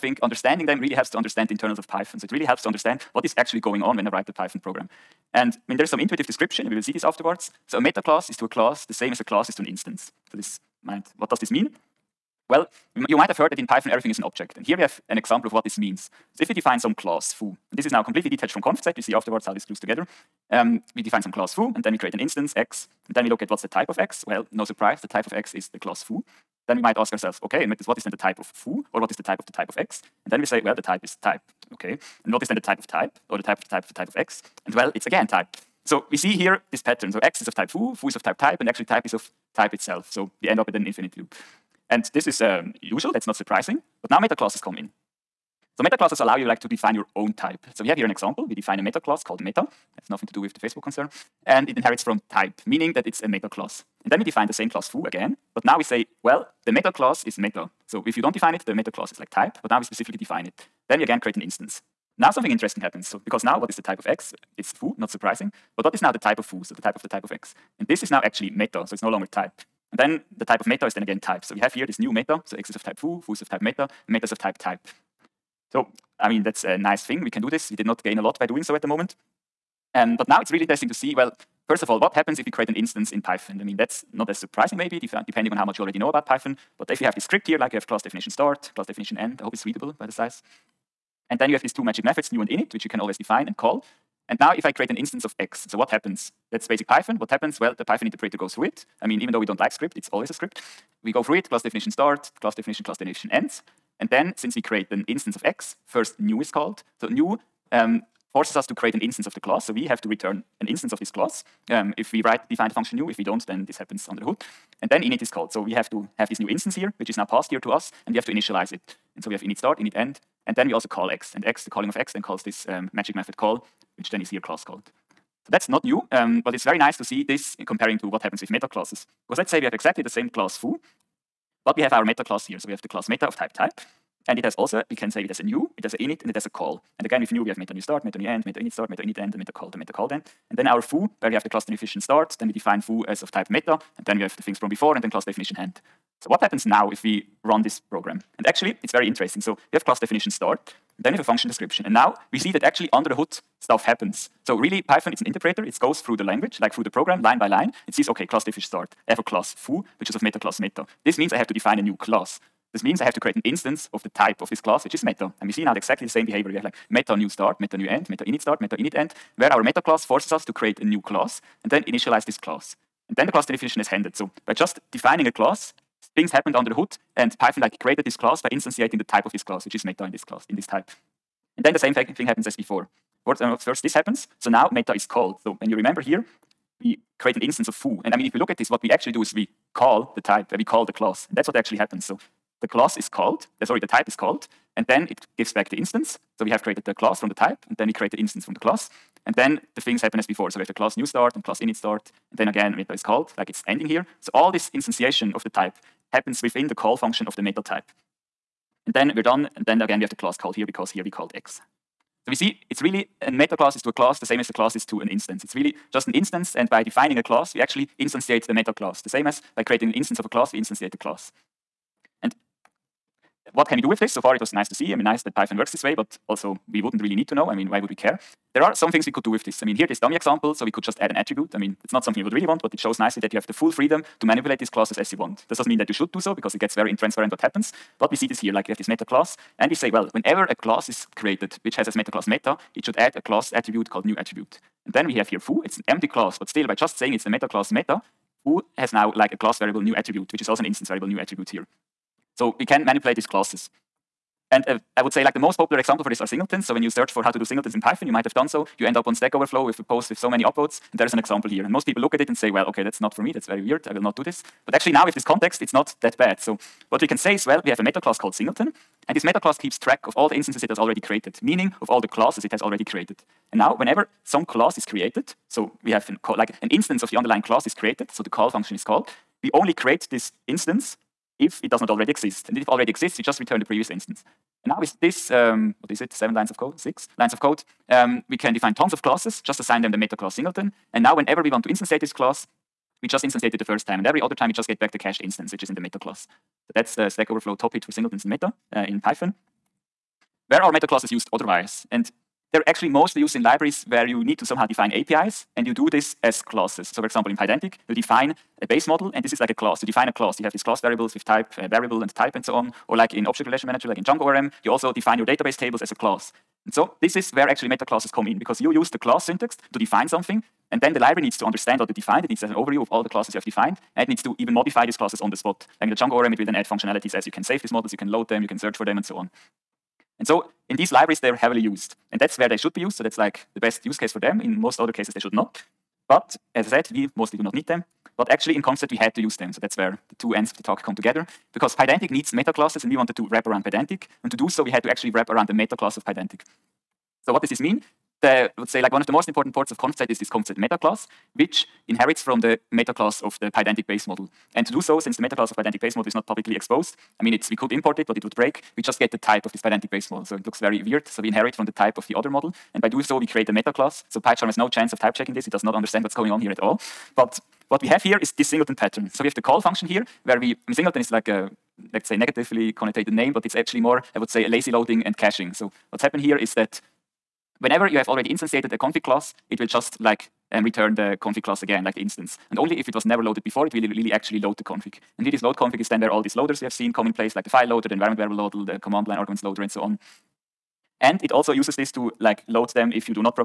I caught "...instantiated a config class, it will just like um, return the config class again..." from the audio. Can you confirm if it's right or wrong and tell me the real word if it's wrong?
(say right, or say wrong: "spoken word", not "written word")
right.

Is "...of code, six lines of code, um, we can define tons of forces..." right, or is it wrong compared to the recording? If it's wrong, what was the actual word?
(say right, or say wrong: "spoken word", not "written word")
wrong: "classes", not "forces".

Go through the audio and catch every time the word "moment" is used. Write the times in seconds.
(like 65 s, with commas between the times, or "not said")
78 s.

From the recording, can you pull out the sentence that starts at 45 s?
So meta classes allow you like to define your own type.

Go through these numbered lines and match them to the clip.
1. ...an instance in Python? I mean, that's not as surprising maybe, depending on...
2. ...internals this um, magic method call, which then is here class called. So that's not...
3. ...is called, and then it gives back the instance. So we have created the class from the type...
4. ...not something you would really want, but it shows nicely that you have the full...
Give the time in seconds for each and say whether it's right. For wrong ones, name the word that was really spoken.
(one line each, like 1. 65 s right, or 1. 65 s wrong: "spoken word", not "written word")
1. 82 s right
2. 122 s wrong: "calls", not "internals"
3. 194 s right
4. 231 s right.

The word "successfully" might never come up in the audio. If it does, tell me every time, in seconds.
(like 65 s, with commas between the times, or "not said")
not said.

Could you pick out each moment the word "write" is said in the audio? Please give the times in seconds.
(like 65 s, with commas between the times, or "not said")
4 s, 112 s.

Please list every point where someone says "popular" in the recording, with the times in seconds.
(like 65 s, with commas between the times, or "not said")
255 s.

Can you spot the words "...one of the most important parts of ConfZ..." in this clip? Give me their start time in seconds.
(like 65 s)
348 s.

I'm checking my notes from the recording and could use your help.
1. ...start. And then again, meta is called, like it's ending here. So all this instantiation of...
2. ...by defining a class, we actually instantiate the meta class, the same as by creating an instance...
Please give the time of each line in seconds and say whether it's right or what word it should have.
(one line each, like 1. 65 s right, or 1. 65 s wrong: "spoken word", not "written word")
1. 201 s right
2. 216 s right.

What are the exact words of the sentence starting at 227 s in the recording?
I mean, why would we care?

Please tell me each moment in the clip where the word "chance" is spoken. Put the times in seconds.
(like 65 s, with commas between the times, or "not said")
364 s.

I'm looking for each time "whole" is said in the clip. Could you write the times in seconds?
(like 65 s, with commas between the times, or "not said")
not said.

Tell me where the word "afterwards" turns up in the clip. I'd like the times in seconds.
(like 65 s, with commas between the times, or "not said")
7 s, 19 s.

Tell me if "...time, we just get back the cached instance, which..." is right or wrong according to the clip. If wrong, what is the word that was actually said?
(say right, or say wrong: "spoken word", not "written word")
right.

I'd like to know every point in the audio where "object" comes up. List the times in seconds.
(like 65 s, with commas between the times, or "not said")
14 s, 313 s.